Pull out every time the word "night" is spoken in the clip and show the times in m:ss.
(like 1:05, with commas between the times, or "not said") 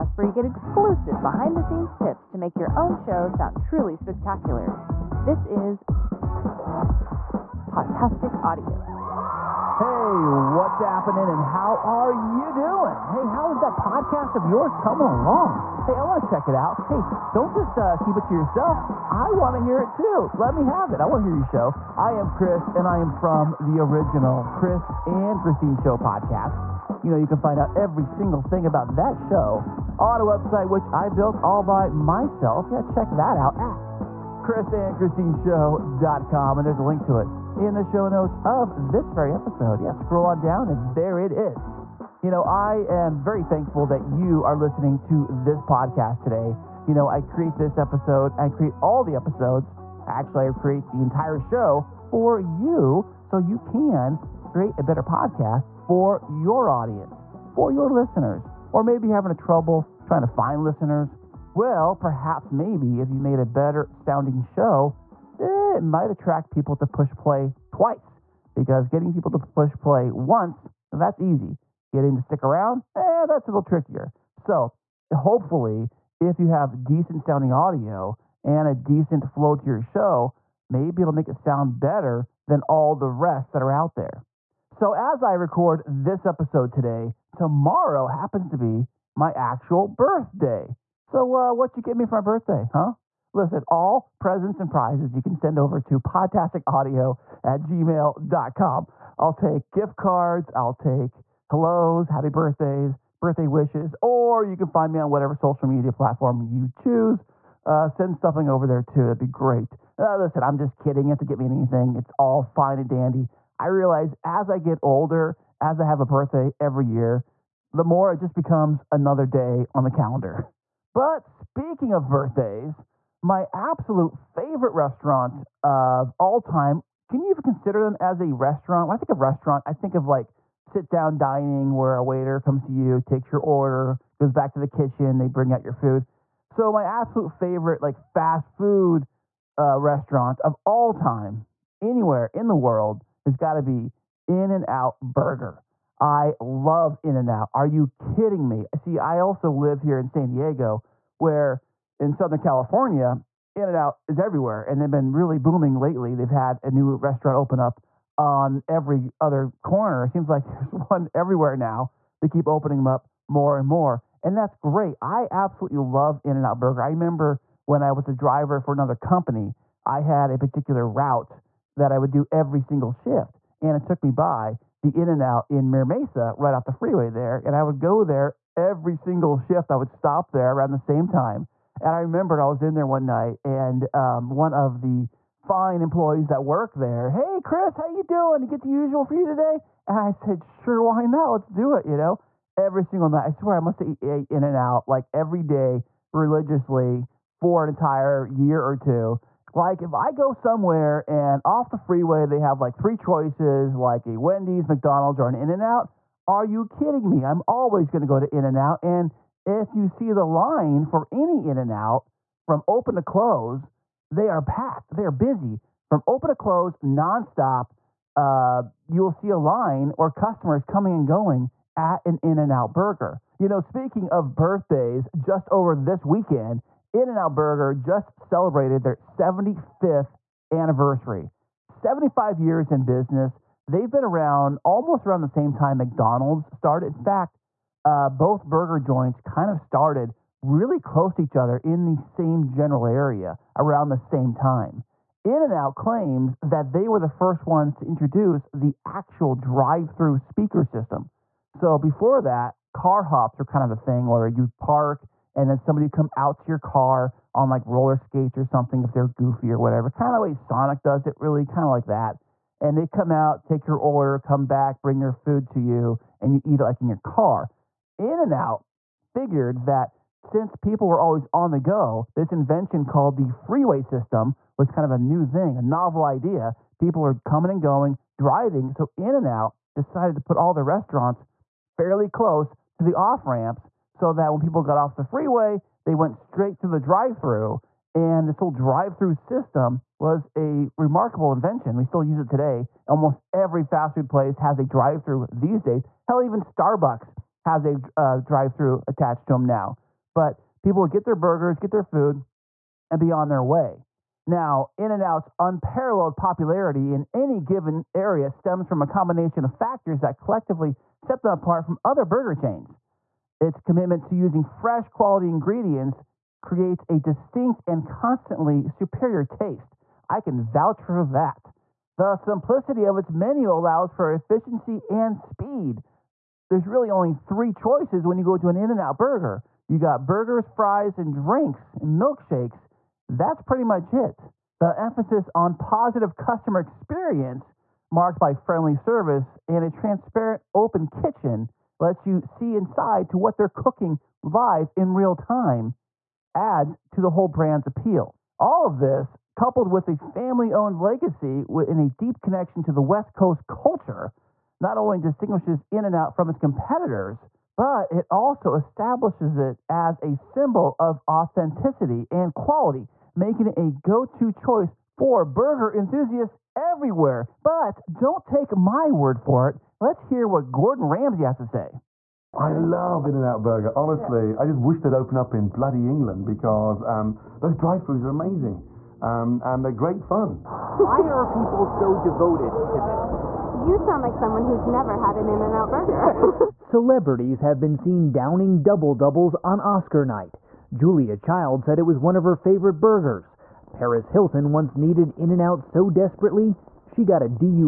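3:03, 3:13, 6:30.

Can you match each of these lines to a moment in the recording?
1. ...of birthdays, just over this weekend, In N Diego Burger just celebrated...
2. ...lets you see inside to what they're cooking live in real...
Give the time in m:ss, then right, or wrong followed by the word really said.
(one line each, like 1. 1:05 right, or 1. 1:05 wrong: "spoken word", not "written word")
1. 3:44 wrong: "Out", not "Diego"
2. 5:41 right.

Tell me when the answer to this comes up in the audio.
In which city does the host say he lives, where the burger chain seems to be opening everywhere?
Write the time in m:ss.
2:30.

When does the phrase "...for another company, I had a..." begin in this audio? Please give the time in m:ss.
2:48.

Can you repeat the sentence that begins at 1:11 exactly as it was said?
Getting to stick around, eh, that's a little trickier.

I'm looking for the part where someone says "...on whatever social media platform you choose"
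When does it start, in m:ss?
1:44.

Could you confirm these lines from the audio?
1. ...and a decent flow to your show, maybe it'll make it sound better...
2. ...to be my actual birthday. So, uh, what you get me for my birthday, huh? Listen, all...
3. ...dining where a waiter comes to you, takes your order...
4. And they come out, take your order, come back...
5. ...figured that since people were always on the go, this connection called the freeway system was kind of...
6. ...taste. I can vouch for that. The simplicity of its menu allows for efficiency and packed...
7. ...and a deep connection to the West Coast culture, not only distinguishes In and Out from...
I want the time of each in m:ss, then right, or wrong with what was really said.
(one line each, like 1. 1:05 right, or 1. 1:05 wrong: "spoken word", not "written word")
1. 1:18 right
2. 1:28 right
3. 2:11 right
4. 4:22 right
5. 4:29 wrong: "invention", not "connection"
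6. 5:19 wrong: "speed", not "packed"
7. 5:51 right.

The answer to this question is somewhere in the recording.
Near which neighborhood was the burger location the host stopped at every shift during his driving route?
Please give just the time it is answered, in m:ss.
2:55.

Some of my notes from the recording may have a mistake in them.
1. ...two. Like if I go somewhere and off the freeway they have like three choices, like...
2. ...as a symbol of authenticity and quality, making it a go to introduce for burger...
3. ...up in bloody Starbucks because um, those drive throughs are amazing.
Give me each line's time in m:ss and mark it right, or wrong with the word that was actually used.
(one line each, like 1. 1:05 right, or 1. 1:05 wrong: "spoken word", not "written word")
1. 3:18 right
2. 5:59 wrong: "choice", not "introduce"
3. 6:15 wrong: "England", not "Starbucks".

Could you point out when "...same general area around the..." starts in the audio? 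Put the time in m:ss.
4:01.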